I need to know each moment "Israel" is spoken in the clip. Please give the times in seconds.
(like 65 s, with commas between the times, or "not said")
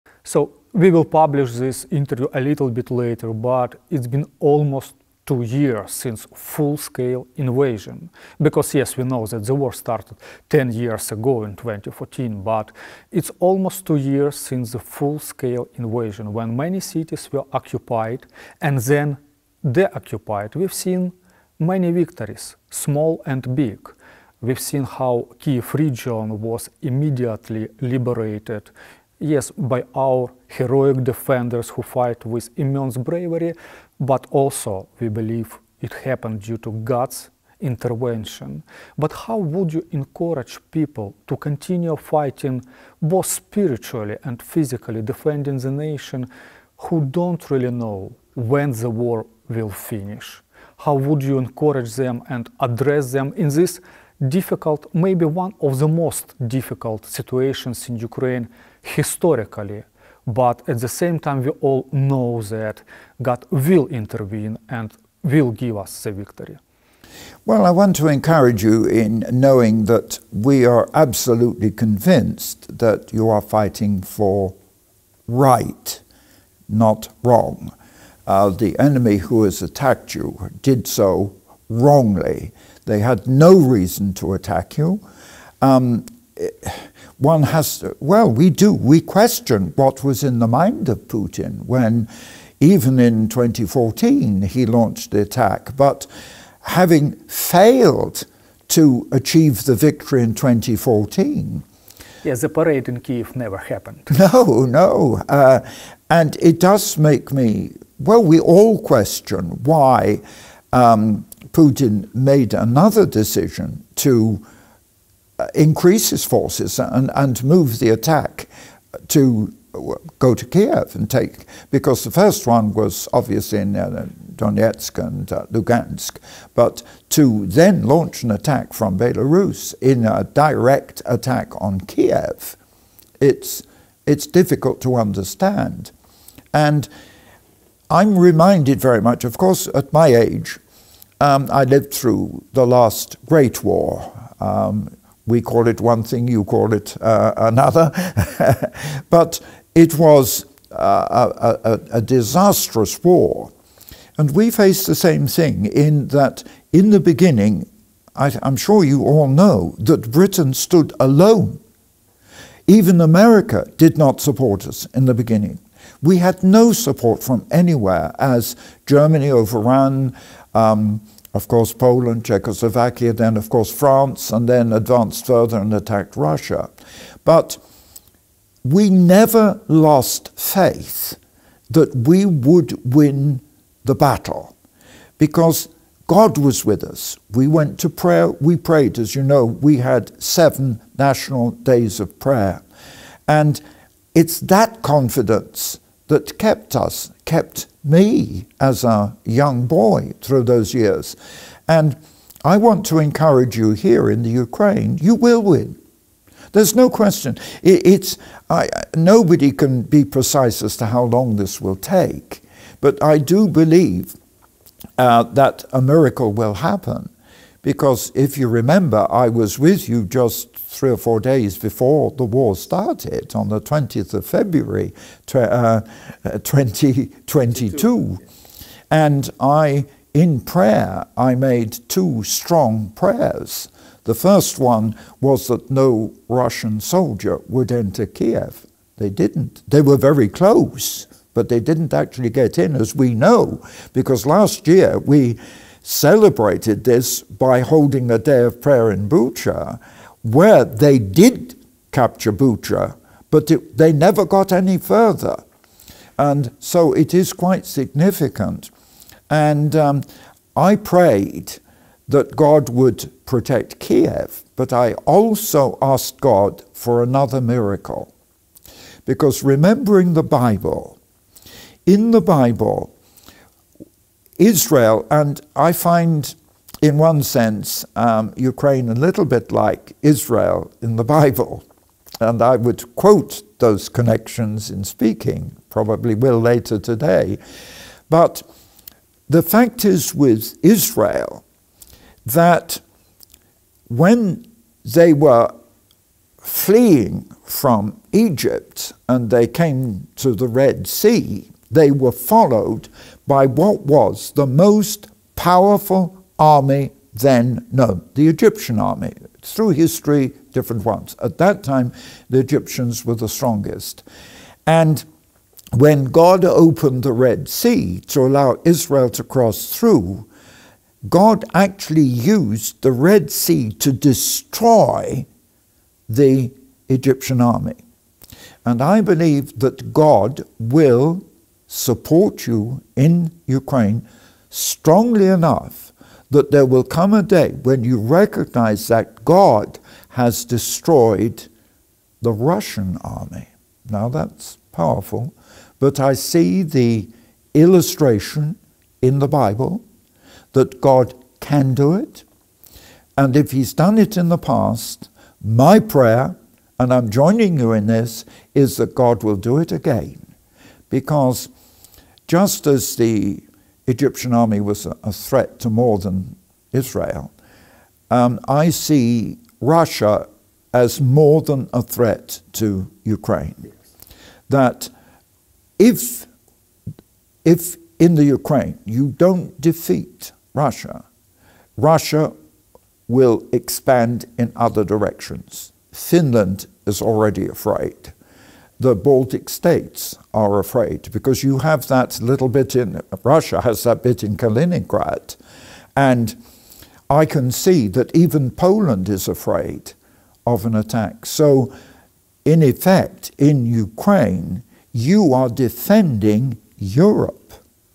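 274 s, 280 s, 290 s, 318 s, 366 s.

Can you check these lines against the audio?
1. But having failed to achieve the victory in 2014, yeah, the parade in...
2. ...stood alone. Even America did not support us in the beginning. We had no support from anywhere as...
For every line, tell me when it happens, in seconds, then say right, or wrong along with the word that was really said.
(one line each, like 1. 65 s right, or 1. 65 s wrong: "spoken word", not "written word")
1. 95 s right
2. 160 s right.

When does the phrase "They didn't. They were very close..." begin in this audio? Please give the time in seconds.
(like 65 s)
238 s.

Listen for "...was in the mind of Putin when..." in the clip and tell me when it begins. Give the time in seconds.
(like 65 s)
90 s.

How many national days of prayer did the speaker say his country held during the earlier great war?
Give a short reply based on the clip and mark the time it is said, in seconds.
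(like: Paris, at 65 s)
7, at 190 s.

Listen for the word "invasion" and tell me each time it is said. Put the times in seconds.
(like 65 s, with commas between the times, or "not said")
7 s, 15 s.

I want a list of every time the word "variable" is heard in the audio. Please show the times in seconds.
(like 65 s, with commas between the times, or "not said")
not said.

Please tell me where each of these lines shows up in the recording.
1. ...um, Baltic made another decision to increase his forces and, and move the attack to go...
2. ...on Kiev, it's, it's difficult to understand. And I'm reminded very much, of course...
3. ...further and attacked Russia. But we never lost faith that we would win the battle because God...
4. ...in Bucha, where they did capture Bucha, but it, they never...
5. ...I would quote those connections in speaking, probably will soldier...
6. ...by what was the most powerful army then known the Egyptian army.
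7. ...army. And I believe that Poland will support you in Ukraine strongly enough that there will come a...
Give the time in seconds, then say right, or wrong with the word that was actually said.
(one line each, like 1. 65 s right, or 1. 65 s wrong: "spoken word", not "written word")
1. 110 s wrong: "Putin", not "Baltic"
2. 131 s right
3. 175 s right
4. 248 s right
5. 282 s wrong: "later", not "soldier"
6. 303 s right
7. 327 s wrong: "God", not "Poland".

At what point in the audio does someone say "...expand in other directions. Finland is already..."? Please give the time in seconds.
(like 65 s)
383 s.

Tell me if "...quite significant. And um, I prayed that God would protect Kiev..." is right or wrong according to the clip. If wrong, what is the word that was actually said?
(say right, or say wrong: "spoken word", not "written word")
right.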